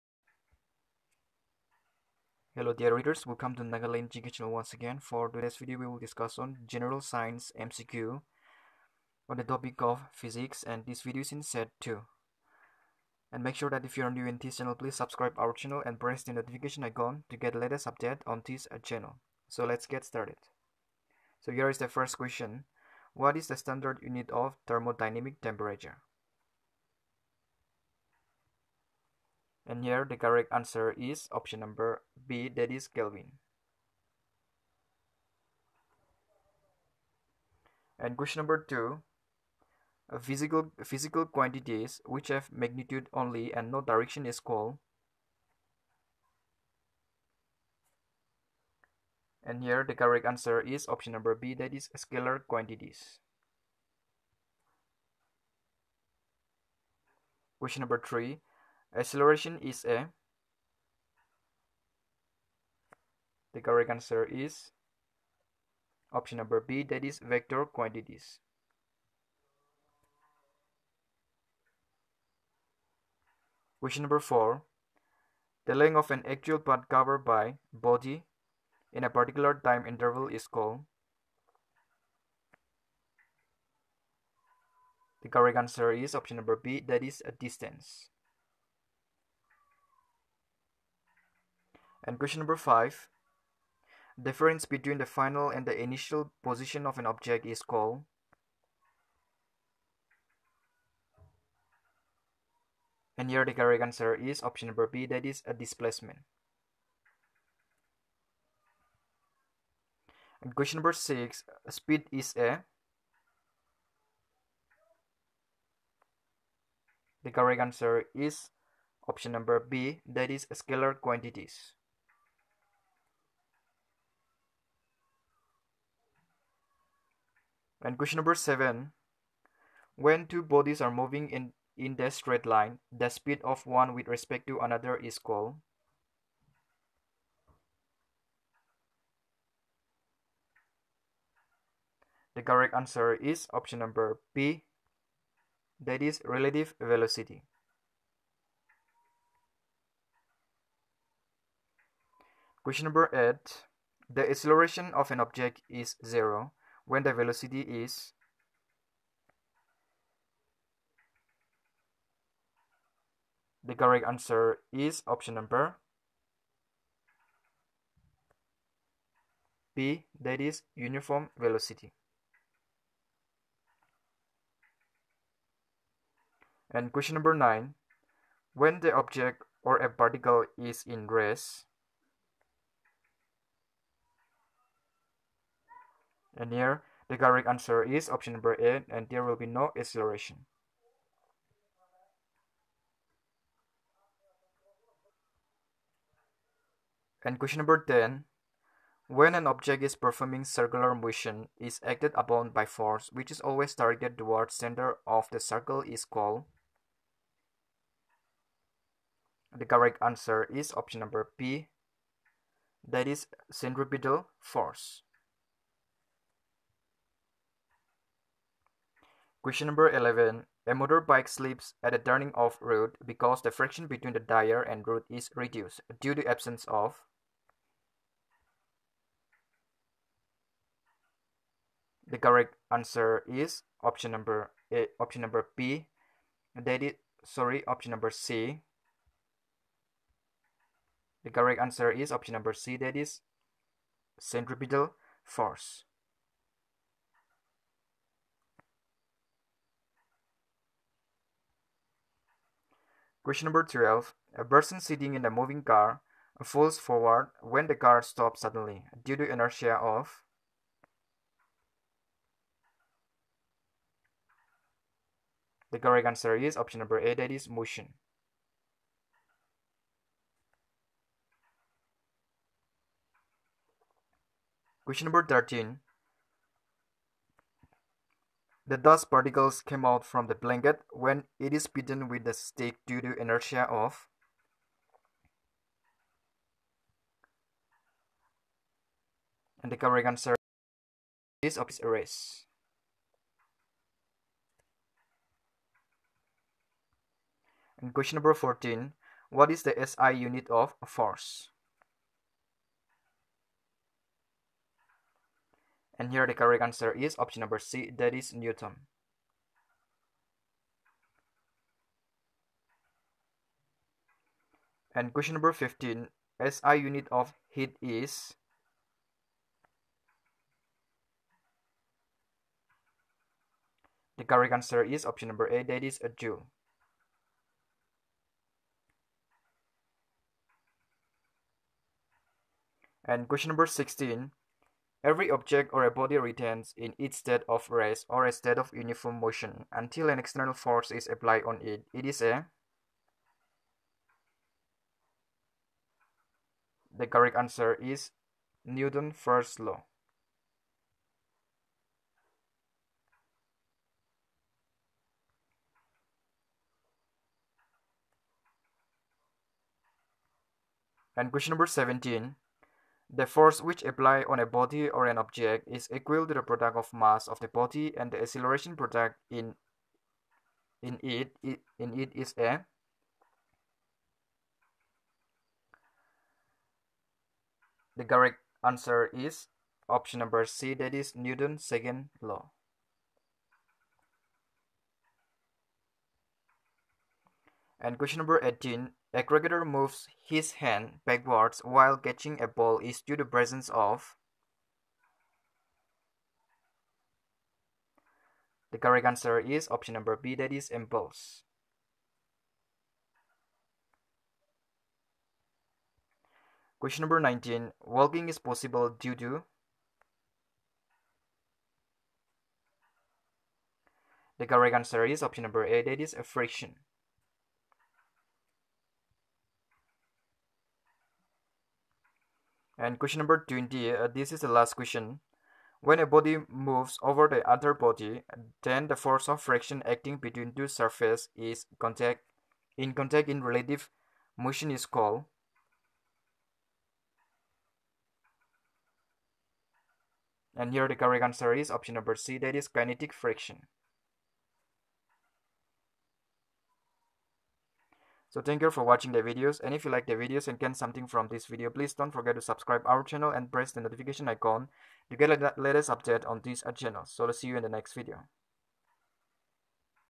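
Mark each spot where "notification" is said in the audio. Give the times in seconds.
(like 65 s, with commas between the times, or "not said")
16 s, 453 s.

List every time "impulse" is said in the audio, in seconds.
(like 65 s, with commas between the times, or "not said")
400 s.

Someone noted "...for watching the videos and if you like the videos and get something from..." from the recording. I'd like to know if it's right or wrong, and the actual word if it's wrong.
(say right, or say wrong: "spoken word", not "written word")
right.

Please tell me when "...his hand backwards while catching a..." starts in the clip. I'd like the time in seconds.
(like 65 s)
390 s.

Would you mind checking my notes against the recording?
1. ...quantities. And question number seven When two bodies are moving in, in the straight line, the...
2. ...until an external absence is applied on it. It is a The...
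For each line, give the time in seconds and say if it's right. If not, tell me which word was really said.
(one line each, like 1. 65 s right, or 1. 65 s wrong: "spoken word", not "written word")
1. 120 s right
2. 339 s wrong: "force", not "absence".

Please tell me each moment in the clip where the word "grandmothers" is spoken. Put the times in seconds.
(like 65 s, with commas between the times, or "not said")
not said.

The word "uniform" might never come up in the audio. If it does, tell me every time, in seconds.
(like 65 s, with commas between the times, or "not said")
170 s, 338 s.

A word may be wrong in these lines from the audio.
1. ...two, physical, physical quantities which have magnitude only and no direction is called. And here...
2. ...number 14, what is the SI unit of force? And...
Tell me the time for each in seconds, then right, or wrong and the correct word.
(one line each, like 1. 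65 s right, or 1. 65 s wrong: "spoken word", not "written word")
1. 38 s right
2. 298 s right.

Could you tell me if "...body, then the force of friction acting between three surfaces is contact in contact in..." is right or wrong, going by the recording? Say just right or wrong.
wrong.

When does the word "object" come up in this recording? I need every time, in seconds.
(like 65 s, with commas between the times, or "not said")
97 s, 155 s, 179 s, 199 s, 335 s, 365 s.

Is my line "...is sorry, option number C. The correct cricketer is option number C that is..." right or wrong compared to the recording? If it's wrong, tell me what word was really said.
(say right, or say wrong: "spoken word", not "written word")
wrong: "answer", not "cricketer".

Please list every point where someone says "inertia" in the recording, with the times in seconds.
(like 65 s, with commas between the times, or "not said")
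259 s, 283 s.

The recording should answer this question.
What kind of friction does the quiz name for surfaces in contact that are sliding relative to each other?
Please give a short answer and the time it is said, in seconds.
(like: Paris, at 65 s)
Kinetic friction, at 442 s.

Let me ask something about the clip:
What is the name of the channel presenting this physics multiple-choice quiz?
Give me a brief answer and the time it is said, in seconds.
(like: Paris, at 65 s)
Nagaland GK, at 3 s.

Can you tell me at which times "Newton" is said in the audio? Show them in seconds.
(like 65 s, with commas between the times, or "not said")
308 s, 348 s, 381 s.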